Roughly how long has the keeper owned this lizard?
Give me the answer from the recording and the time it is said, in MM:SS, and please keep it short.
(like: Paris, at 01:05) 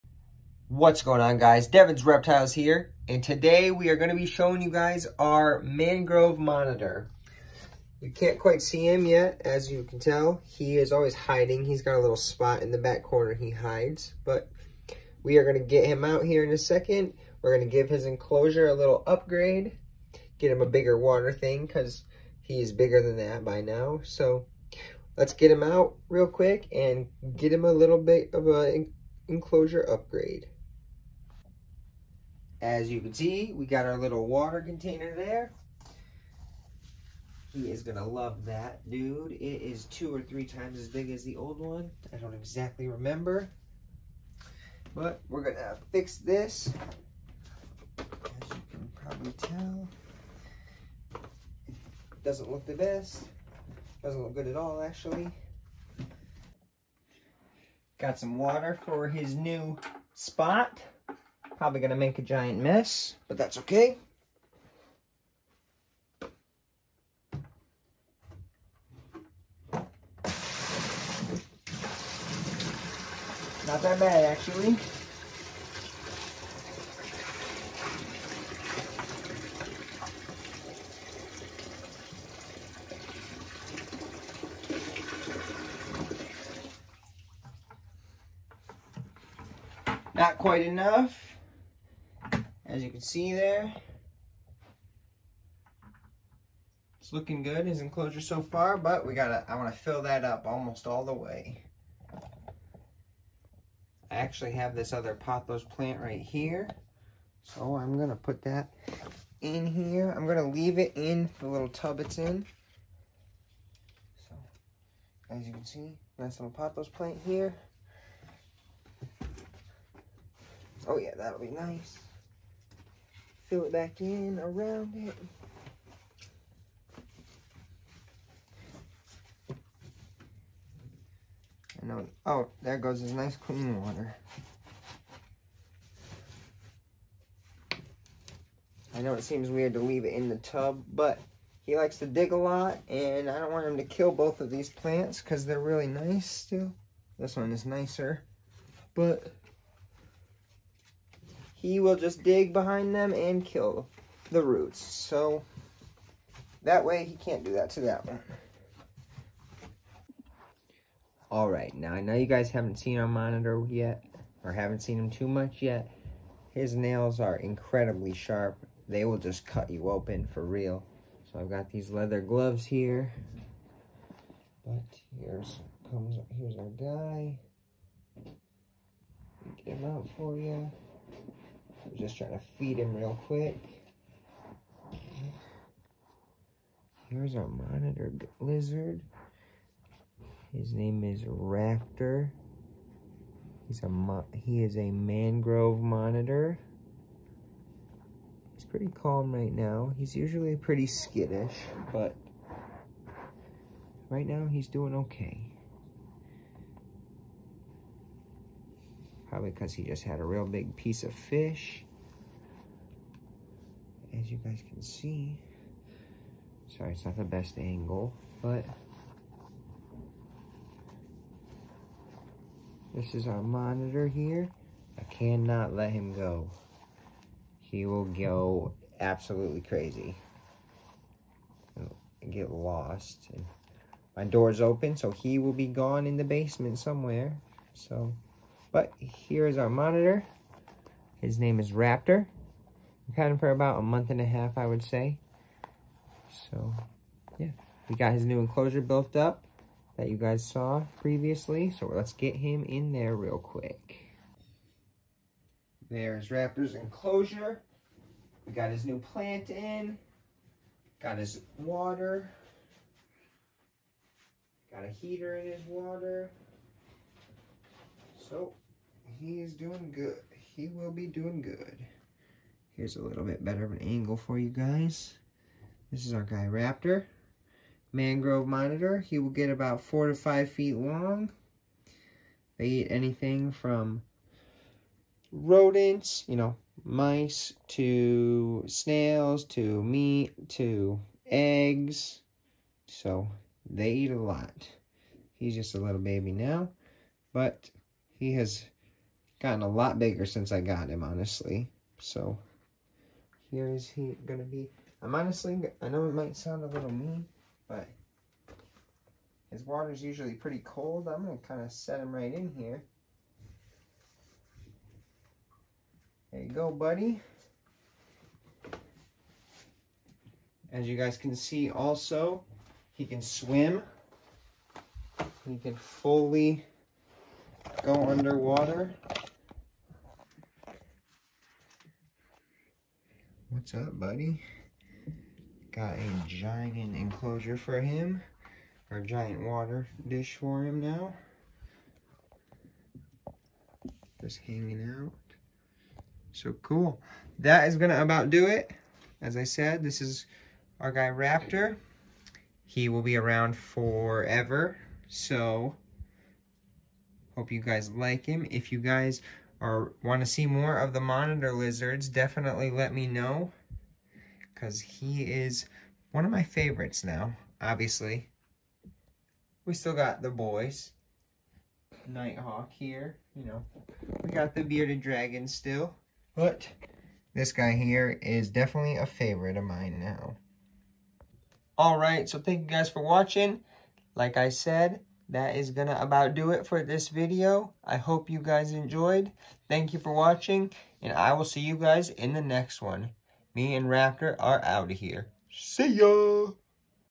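About a month and a half, at 04:03.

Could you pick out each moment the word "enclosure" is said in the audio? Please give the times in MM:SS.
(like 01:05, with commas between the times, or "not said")
00:18, 00:29, 01:37, 04:08, 04:16, 05:36.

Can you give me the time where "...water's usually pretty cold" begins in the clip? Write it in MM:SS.
05:09.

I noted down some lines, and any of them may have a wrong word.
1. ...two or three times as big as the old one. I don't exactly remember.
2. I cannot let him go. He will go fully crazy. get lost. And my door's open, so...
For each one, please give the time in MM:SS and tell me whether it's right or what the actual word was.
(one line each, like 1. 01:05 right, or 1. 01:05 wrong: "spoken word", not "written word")
1. 00:39 right
2. 03:44 wrong: "absolutely", not "fully".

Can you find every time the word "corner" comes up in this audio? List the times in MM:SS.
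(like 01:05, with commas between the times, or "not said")
00:13.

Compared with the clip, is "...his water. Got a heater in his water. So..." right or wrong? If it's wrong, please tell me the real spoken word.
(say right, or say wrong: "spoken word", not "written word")
right.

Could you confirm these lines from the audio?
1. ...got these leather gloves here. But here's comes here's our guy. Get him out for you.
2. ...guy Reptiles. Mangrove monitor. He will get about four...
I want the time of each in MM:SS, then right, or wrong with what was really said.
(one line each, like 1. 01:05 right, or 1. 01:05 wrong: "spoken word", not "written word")
1. 02:51 right
2. 04:36 wrong: "Raptor", not "Reptiles".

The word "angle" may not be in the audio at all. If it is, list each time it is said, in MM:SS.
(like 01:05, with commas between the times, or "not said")
03:37, 04:33.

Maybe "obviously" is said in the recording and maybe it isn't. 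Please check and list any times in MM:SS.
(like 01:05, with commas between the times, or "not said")
06:07.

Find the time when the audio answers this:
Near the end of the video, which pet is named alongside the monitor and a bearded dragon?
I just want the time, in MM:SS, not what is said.
06:12.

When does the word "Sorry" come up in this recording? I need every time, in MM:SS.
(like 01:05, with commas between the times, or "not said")
03:36.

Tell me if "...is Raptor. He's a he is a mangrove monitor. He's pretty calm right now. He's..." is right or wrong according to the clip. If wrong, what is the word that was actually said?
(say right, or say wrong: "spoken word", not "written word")
right.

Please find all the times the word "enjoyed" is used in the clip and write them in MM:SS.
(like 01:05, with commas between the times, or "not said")
06:28.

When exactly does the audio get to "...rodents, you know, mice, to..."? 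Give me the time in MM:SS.
04:45.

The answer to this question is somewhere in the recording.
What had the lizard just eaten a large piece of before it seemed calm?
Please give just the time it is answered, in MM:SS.
03:31.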